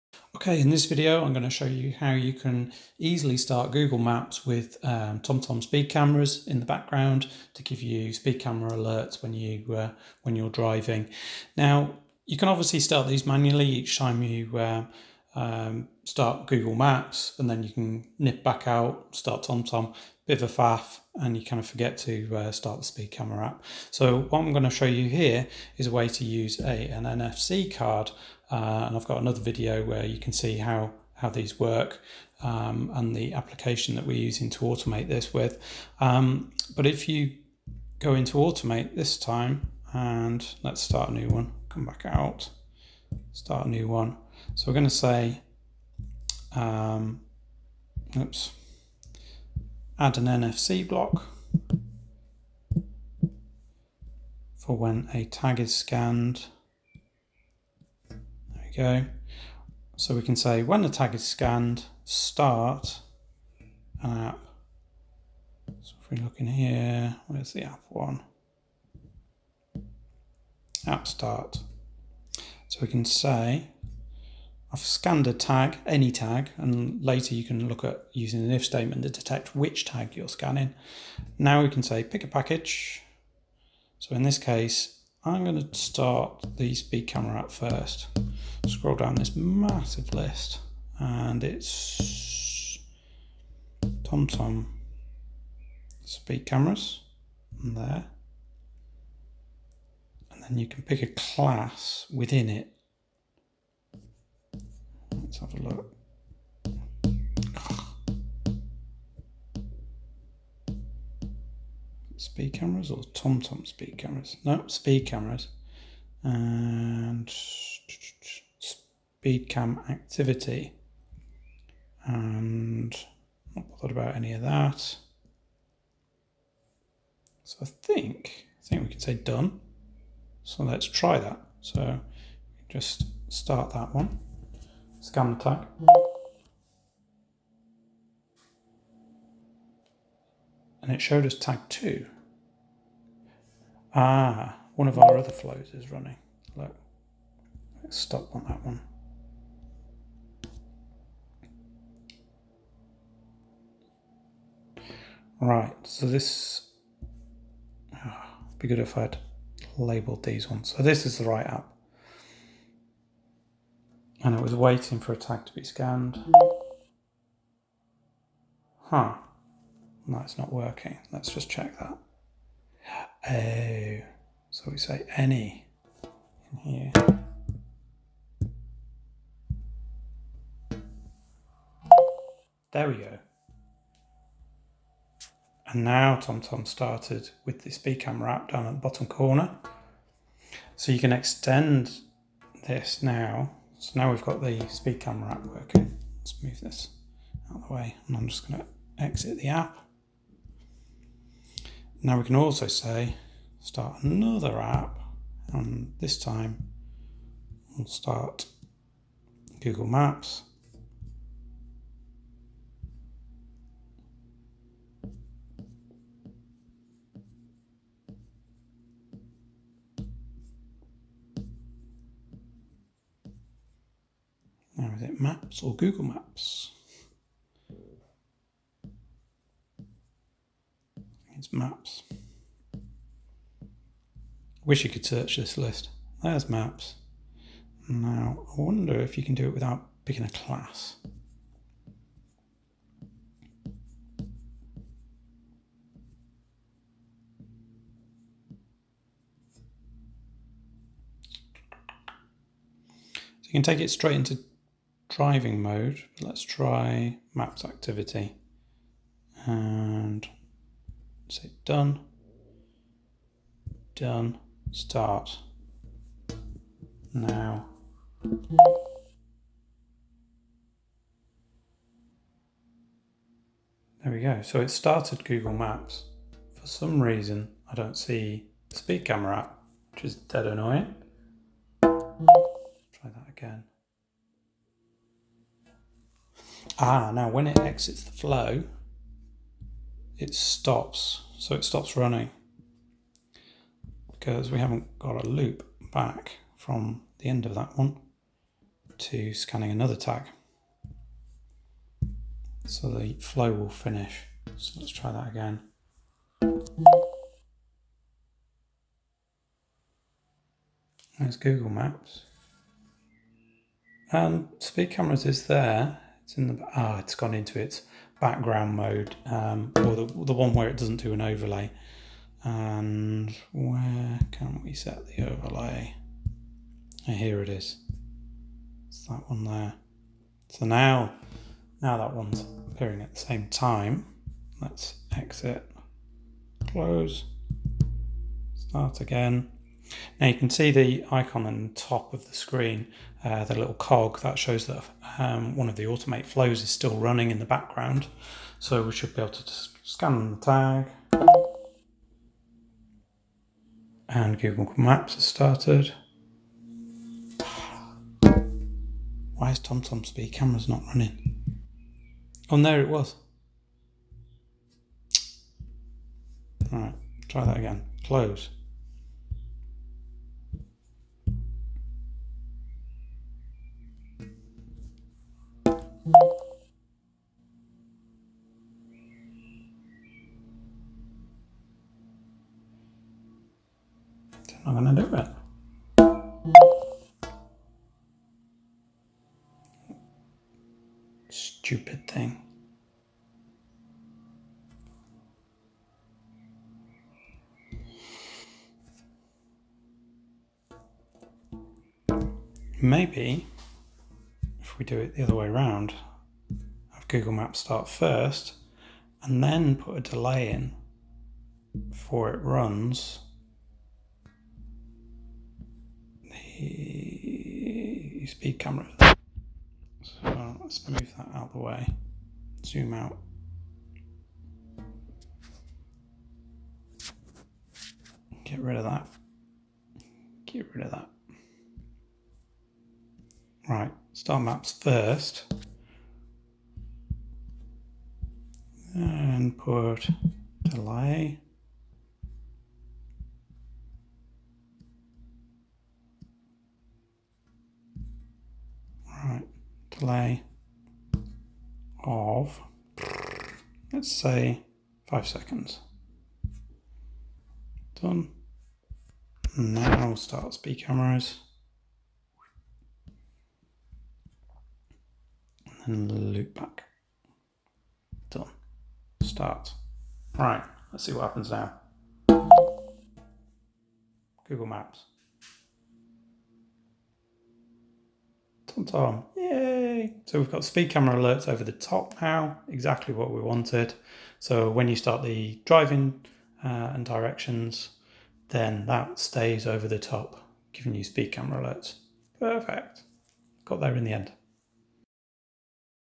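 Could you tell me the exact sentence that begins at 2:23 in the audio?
Ah, one of our other flows is running.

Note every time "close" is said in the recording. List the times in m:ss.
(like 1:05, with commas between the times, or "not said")
5:36, 6:08.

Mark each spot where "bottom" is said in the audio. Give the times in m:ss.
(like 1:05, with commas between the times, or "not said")
3:08.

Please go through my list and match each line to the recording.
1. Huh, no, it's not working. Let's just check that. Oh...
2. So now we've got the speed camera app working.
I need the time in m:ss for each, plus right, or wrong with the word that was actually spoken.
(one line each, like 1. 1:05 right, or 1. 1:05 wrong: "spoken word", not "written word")
1. 2:48 right
2. 3:13 right.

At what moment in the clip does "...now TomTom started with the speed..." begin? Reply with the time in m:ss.
3:05.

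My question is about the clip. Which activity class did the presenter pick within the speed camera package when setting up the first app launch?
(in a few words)
speed cam activity.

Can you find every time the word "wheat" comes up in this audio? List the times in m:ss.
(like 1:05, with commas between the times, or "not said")
not said.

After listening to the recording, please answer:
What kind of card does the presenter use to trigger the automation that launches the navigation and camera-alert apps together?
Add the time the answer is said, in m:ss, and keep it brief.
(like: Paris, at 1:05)
NFC card, at 0:27.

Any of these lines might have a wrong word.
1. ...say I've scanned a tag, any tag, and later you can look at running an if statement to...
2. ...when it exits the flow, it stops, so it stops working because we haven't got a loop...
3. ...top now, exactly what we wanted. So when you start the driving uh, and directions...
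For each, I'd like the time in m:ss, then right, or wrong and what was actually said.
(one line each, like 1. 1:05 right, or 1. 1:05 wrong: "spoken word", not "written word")
1. 1:13 wrong: "using", not "running"
2. 4:47 wrong: "running", not "working"
3. 8:01 right.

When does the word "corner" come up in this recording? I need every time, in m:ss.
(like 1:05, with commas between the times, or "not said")
3:09.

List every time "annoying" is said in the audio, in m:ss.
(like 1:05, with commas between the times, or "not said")
4:40.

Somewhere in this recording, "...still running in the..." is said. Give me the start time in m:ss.
5:46.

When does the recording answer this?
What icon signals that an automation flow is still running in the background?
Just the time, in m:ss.
5:43.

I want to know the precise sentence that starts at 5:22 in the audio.
And where can we set the overlay?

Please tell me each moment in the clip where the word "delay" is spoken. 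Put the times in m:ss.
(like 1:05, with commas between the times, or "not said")
6:50, 7:20, 7:30.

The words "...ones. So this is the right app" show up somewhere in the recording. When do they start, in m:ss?
2:40.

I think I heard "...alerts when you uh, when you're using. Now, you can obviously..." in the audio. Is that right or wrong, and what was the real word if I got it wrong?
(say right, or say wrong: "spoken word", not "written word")
wrong: "driving", not "using".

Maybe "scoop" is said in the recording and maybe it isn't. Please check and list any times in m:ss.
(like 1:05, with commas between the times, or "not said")
not said.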